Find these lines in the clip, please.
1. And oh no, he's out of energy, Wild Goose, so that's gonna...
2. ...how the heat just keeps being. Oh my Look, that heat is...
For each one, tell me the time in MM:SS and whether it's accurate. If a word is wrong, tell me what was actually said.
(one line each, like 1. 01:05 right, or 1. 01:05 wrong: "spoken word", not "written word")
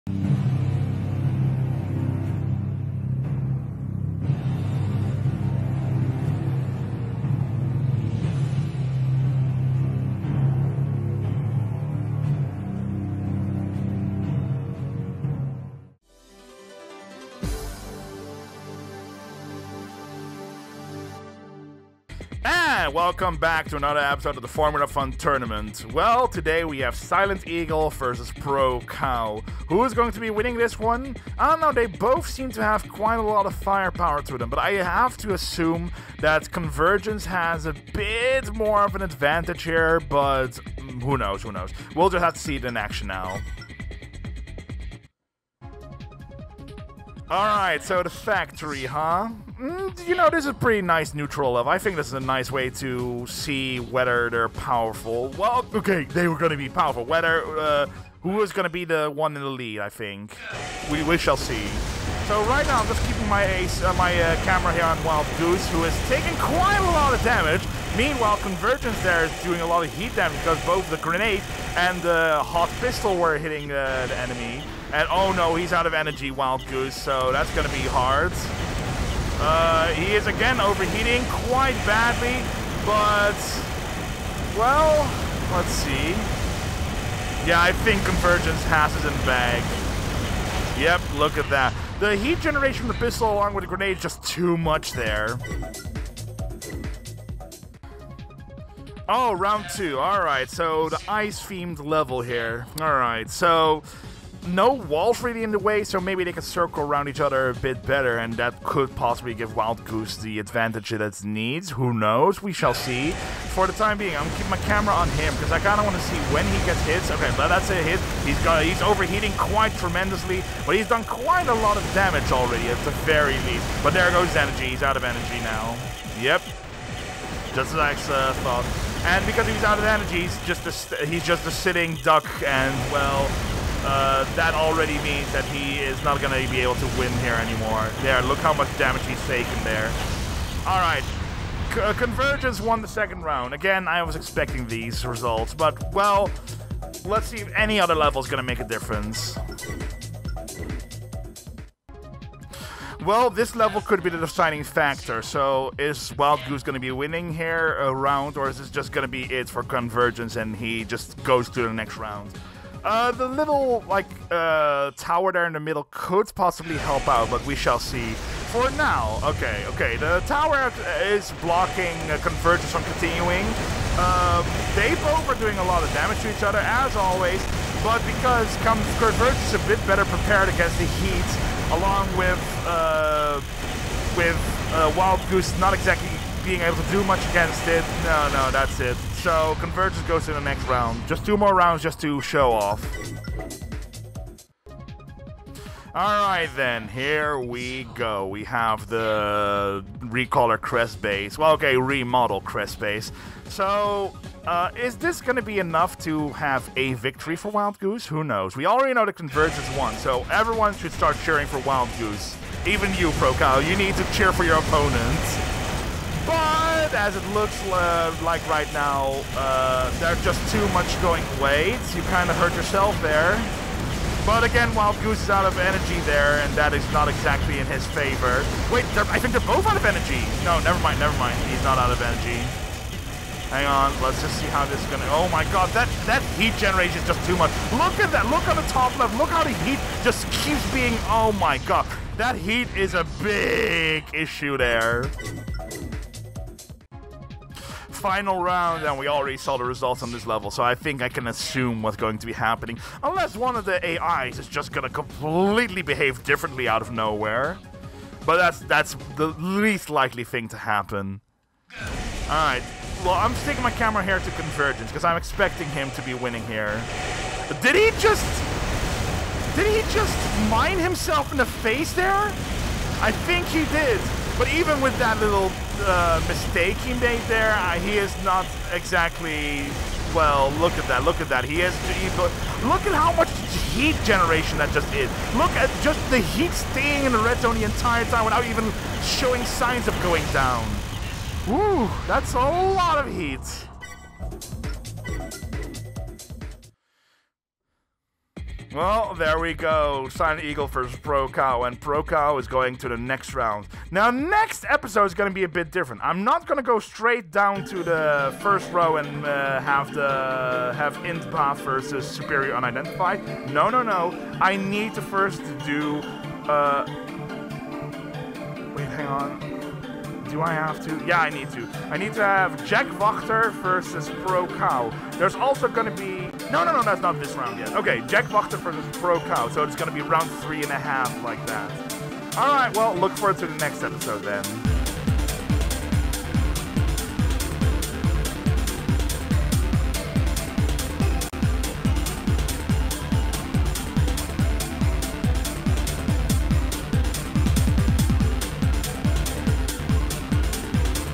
1. 01:14 right
2. 03:59 wrong: "God", not "Look".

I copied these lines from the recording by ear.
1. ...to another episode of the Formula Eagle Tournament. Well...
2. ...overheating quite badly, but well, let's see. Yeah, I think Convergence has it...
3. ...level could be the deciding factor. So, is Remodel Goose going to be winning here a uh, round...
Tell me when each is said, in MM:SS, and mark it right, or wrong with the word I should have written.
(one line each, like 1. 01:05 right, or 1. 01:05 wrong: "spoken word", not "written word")
1. 00:23 wrong: "Front", not "Eagle"
2. 01:20 right
3. 02:33 wrong: "Wild", not "Remodel".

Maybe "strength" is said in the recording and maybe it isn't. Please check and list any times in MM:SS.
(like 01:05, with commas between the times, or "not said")
not said.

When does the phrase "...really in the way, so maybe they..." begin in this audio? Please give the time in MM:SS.
01:45.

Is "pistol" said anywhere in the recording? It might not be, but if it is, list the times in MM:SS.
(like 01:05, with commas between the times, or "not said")
01:12, 01:32.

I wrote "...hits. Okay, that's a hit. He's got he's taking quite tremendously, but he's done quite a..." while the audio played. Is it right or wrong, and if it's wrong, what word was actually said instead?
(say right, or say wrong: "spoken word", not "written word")
wrong: "overheating", not "taking".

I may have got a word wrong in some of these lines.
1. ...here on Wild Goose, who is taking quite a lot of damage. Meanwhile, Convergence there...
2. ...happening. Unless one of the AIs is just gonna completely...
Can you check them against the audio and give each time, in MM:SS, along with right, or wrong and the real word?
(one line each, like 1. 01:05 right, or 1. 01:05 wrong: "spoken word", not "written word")
1. 01:04 right
2. 04:12 right.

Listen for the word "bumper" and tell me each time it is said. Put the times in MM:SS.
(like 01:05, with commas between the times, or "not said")
not said.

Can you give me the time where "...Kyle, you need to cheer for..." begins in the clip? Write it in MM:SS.
03:33.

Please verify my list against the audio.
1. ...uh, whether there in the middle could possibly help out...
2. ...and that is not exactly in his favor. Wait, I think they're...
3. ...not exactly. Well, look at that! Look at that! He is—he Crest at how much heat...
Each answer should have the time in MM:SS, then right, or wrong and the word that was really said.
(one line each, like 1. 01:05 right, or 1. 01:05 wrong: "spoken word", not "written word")
1. 02:44 wrong: "tower", not "whether"
2. 03:46 right
3. 04:38 wrong: "Look", not "Crest".